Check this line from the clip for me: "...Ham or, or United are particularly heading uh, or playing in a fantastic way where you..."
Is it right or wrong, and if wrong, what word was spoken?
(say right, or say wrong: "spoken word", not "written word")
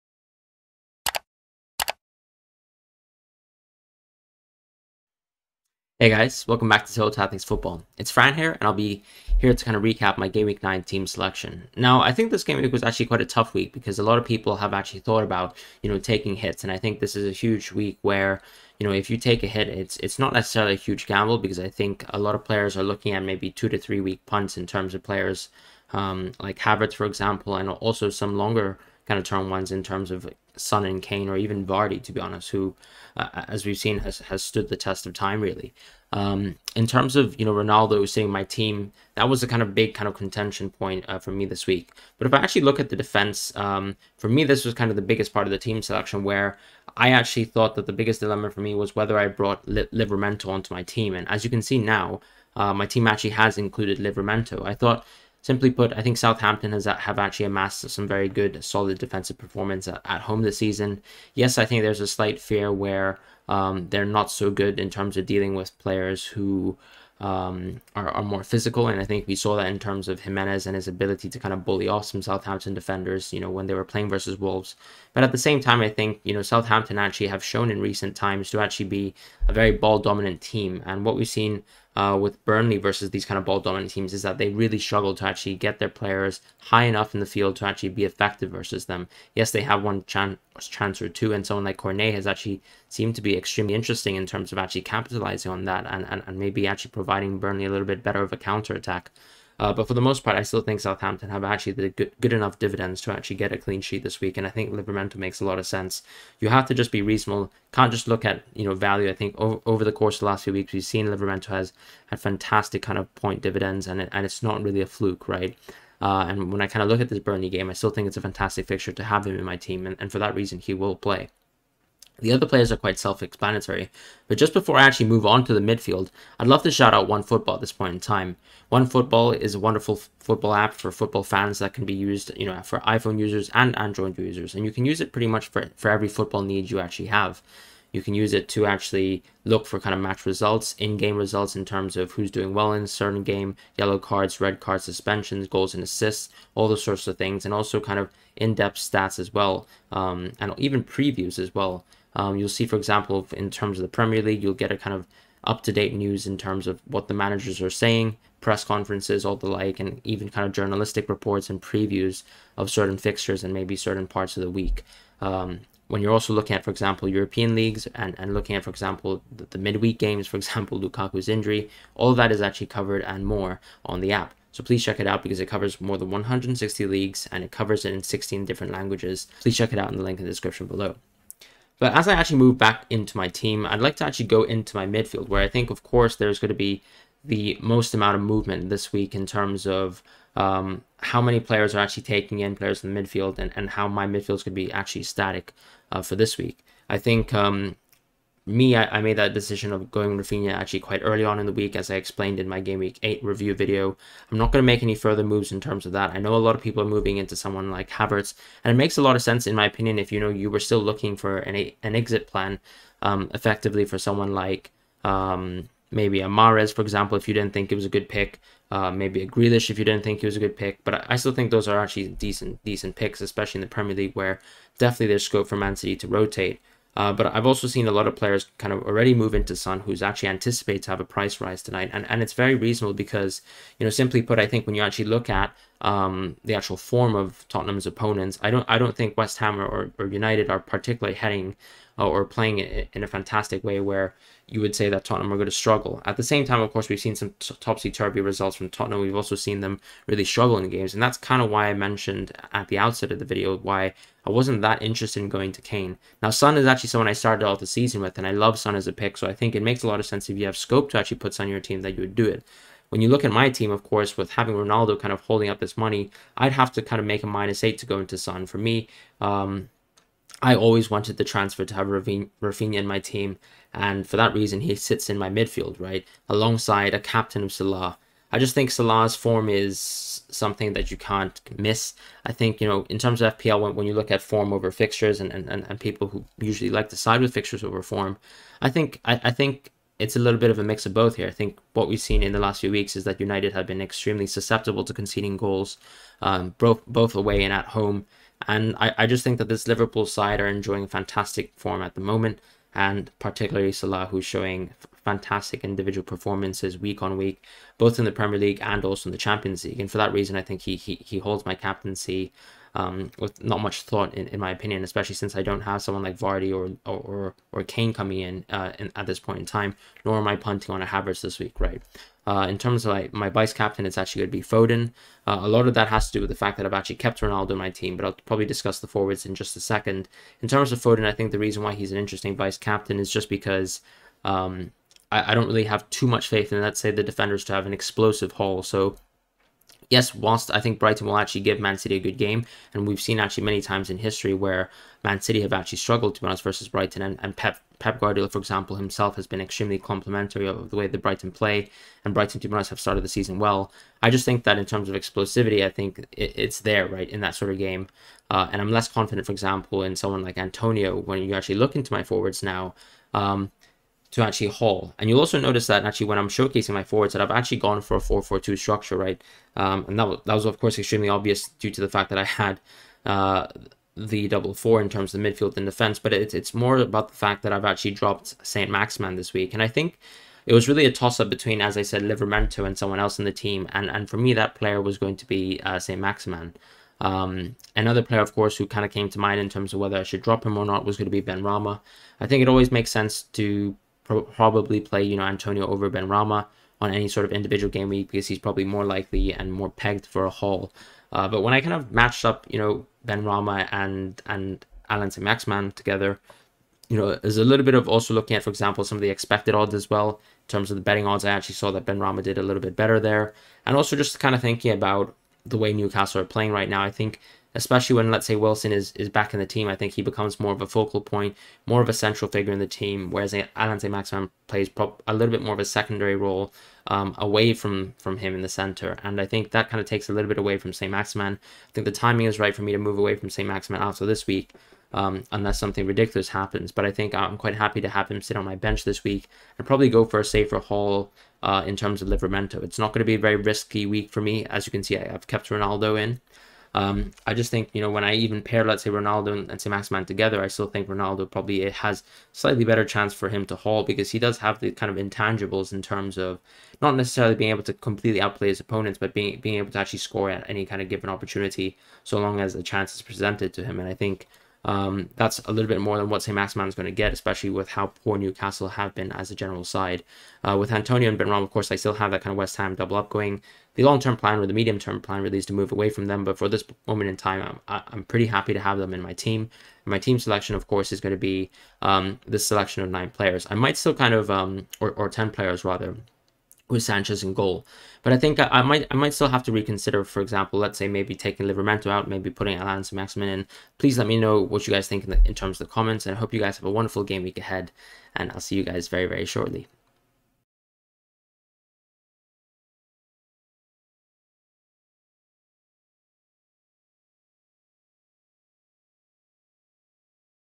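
right.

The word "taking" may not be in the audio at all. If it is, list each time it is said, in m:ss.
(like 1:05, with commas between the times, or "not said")
0:15, 3:12, 8:11.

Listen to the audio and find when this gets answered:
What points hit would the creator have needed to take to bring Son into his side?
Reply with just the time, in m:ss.
4:27.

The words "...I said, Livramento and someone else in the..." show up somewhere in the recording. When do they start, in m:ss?
6:21.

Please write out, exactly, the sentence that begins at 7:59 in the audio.
my team selection, of course, is going to be um, this selection of nine players.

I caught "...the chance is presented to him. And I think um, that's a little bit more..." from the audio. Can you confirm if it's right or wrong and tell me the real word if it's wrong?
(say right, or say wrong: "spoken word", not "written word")
right.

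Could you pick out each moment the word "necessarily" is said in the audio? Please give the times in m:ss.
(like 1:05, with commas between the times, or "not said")
0:20, 7:36.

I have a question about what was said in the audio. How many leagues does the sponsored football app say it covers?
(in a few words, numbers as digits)
160.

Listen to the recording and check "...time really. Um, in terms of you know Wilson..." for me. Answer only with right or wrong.
wrong.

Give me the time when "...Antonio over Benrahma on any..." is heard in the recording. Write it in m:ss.
6:35.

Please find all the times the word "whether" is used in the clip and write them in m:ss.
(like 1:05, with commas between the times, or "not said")
0:48, 6:29.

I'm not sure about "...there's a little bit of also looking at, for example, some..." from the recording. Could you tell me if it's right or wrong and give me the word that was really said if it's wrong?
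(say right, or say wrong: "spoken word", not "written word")
right.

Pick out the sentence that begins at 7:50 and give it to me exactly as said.
Uh, with Antonio and Benrahma, of course, I still have that kind of West Ham double up going.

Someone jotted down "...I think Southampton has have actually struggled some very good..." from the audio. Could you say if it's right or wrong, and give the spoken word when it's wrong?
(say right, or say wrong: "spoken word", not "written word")
wrong: "amassed", not "struggled".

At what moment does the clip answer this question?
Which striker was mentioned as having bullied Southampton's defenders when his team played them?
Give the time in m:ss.
1:10.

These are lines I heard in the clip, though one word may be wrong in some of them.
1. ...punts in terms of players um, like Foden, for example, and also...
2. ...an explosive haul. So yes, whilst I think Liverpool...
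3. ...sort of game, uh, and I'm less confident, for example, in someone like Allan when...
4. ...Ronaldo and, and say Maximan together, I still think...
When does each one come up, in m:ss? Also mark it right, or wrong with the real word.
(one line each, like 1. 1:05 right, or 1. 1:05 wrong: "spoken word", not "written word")
1. 0:24 wrong: "Havertz", not "Foden"
2. 5:37 wrong: "Brighton", not "Liverpool"
3. 5:57 wrong: "Antonio", not "Allan"
4. 7:28 right.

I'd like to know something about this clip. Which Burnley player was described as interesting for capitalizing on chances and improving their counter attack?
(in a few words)
Cornet.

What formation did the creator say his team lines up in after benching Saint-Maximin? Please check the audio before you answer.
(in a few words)
4-4-2.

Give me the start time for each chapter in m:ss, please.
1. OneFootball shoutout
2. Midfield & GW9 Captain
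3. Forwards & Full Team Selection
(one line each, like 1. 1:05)
1. 2:04
2. 3:00
3. 6:15.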